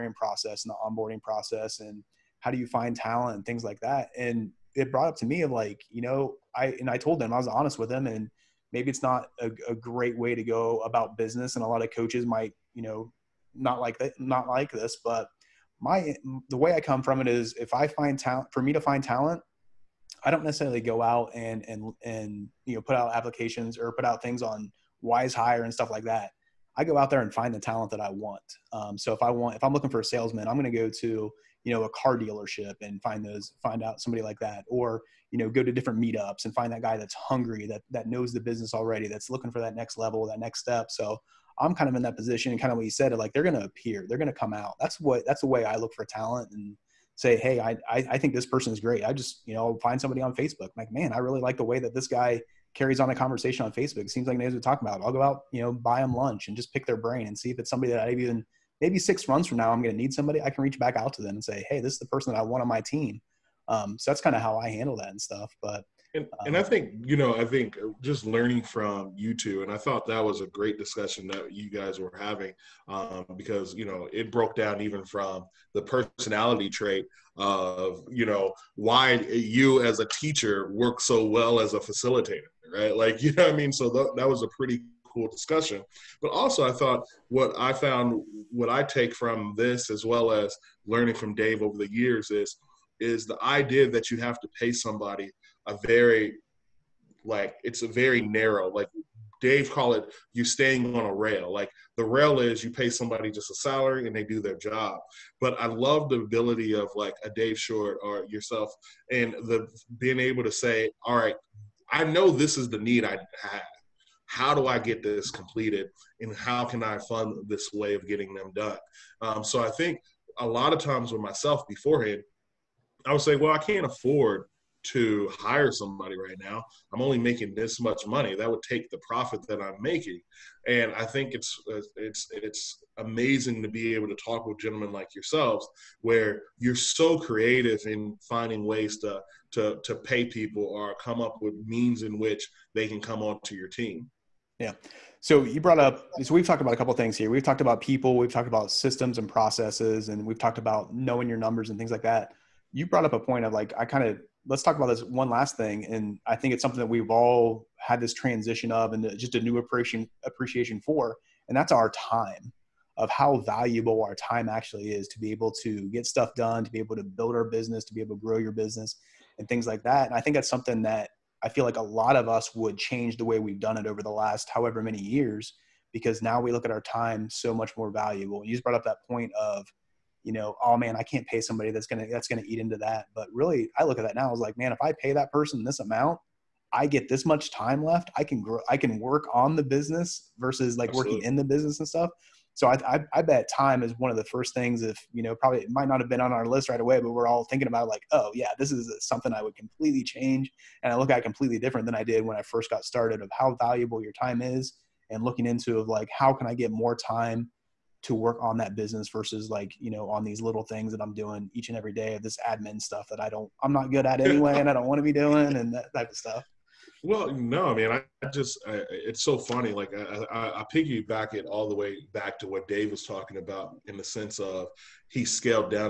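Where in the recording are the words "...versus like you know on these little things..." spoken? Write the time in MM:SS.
03:29.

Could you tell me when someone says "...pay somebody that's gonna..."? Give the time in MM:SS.
03:01.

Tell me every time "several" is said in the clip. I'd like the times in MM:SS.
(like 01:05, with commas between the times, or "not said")
not said.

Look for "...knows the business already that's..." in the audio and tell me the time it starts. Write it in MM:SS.
00:38.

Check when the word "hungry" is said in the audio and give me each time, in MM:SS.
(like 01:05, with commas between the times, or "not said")
00:37.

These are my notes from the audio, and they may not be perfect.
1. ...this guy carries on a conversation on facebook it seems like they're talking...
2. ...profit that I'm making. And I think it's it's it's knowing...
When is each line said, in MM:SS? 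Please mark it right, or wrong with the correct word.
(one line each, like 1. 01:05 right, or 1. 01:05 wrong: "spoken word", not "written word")
1. 00:51 right
2. 02:09 wrong: "amazing", not "knowing".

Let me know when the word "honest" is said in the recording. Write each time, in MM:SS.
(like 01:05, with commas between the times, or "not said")
00:07.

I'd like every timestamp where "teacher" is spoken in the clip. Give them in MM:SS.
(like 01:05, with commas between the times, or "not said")
01:20.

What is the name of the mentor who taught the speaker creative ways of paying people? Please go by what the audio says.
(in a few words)
Dave Short.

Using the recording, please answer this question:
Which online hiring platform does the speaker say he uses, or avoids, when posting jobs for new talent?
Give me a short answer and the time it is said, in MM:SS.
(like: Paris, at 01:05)
Wizehire, at 00:25.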